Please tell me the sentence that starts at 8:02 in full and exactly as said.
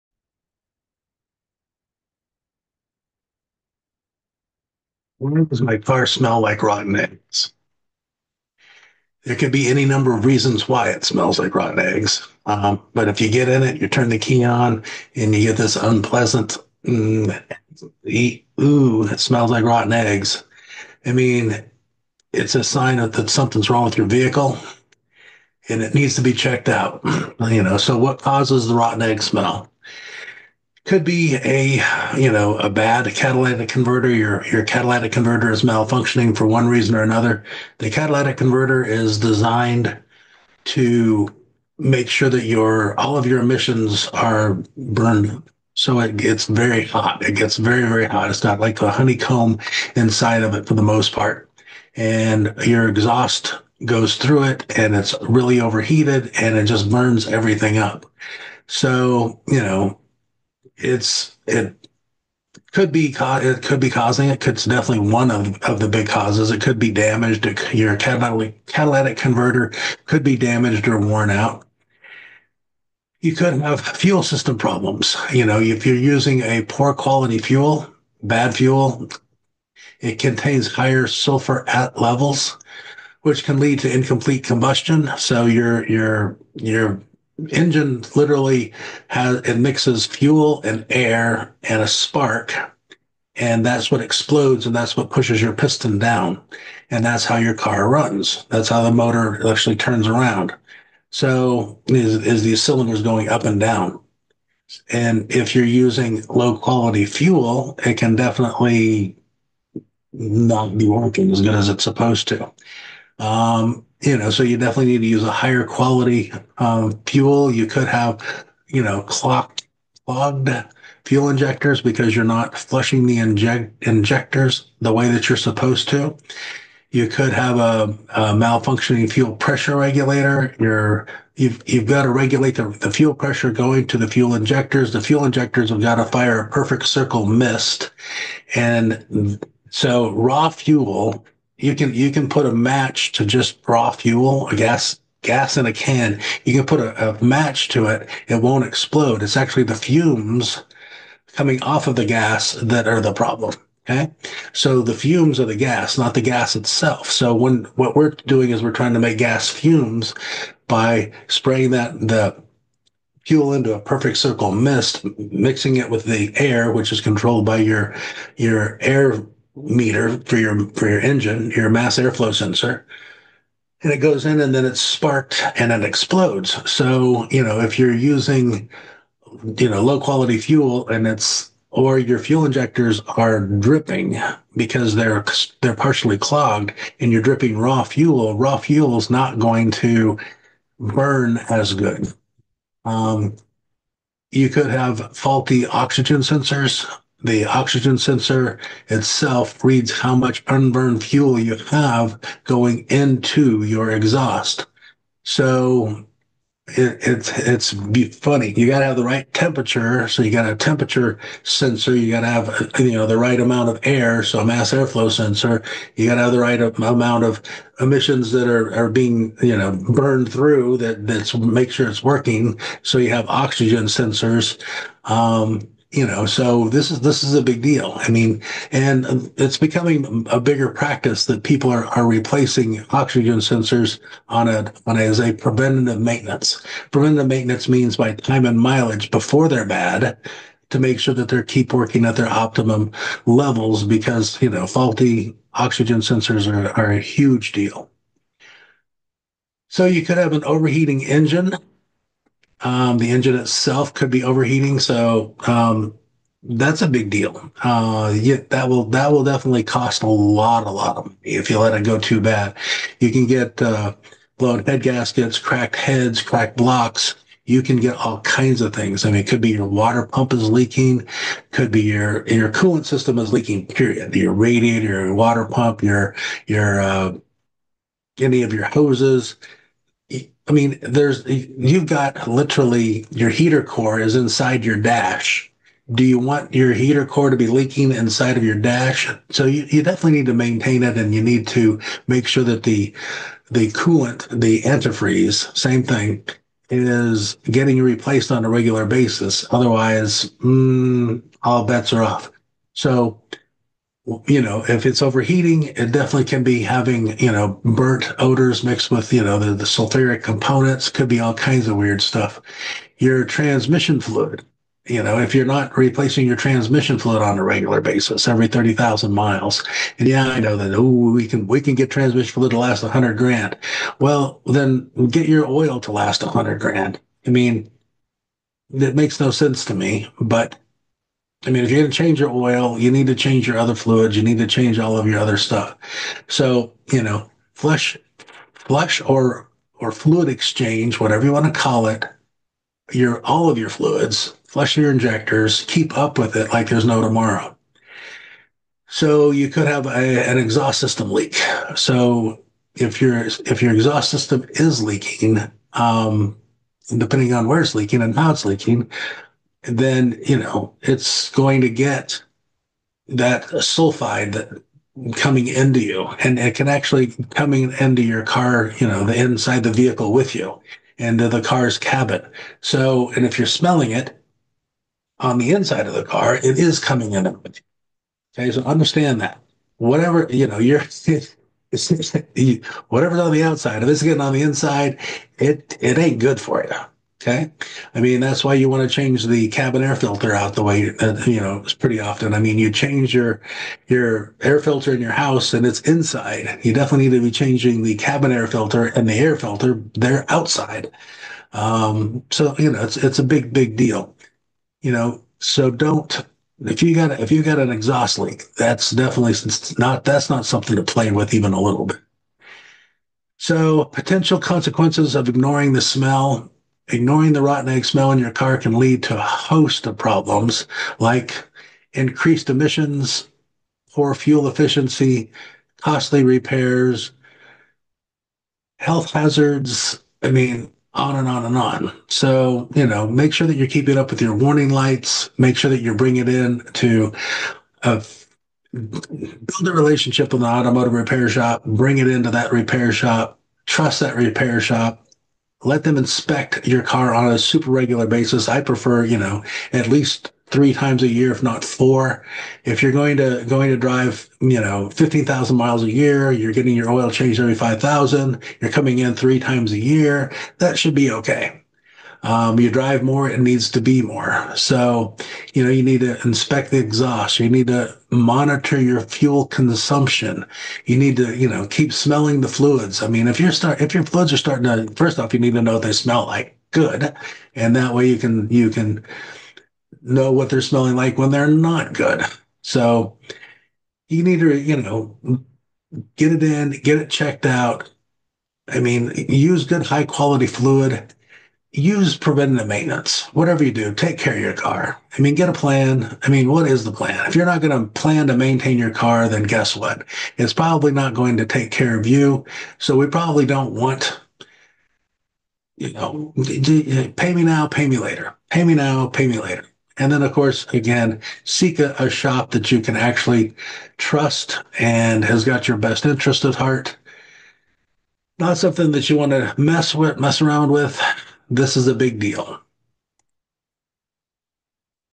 So you need to, you know, get it in, get it checked out.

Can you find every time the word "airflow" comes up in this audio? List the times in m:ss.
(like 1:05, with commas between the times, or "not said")
2:51, 3:34.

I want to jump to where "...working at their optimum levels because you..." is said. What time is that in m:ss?
4:01.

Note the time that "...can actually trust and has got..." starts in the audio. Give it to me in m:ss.
8:32.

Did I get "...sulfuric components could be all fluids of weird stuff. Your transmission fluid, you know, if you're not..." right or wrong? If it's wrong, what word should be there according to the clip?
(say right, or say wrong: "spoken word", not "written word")
wrong: "kinds", not "fluids".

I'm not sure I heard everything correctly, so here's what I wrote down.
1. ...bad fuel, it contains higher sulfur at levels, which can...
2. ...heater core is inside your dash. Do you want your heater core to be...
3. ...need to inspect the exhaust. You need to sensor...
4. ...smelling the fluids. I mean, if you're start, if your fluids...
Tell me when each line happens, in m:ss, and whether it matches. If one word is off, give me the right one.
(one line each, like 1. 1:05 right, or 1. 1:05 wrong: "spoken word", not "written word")
1. 1:18 right
2. 4:43 right
3. 7:45 wrong: "monitor", not "sensor"
4. 7:51 right.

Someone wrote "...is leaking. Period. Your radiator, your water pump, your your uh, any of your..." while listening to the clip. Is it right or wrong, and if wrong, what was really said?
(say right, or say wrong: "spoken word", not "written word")
right.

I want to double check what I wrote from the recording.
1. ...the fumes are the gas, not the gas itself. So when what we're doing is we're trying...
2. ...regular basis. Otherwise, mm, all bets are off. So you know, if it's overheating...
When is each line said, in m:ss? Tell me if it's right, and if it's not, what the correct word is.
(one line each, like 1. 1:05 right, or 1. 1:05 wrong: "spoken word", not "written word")
1. 2:34 right
2. 4:58 right.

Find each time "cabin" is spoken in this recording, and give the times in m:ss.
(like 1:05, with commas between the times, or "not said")
6:11, 6:29, 6:37.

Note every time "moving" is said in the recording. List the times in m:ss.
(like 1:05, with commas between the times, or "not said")
not said.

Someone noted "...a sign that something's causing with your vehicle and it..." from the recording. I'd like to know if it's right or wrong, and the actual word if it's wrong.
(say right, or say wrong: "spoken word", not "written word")
wrong: "wrong", not "causing".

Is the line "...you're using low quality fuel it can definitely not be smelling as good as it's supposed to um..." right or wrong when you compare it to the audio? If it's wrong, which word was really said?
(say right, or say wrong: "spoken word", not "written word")
wrong: "working", not "smelling".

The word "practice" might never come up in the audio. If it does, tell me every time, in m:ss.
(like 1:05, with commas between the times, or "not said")
3:50.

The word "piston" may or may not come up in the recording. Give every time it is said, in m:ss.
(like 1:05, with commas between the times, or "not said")
1:35.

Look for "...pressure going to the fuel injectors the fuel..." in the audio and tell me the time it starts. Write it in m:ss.
2:13.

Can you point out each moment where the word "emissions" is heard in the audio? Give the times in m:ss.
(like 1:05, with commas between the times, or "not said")
0:43, 3:37, 7:02.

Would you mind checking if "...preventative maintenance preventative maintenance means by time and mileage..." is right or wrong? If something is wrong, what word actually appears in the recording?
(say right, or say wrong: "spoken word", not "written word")
right.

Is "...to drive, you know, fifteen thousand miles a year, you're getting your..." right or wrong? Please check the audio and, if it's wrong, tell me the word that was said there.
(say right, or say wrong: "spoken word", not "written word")
right.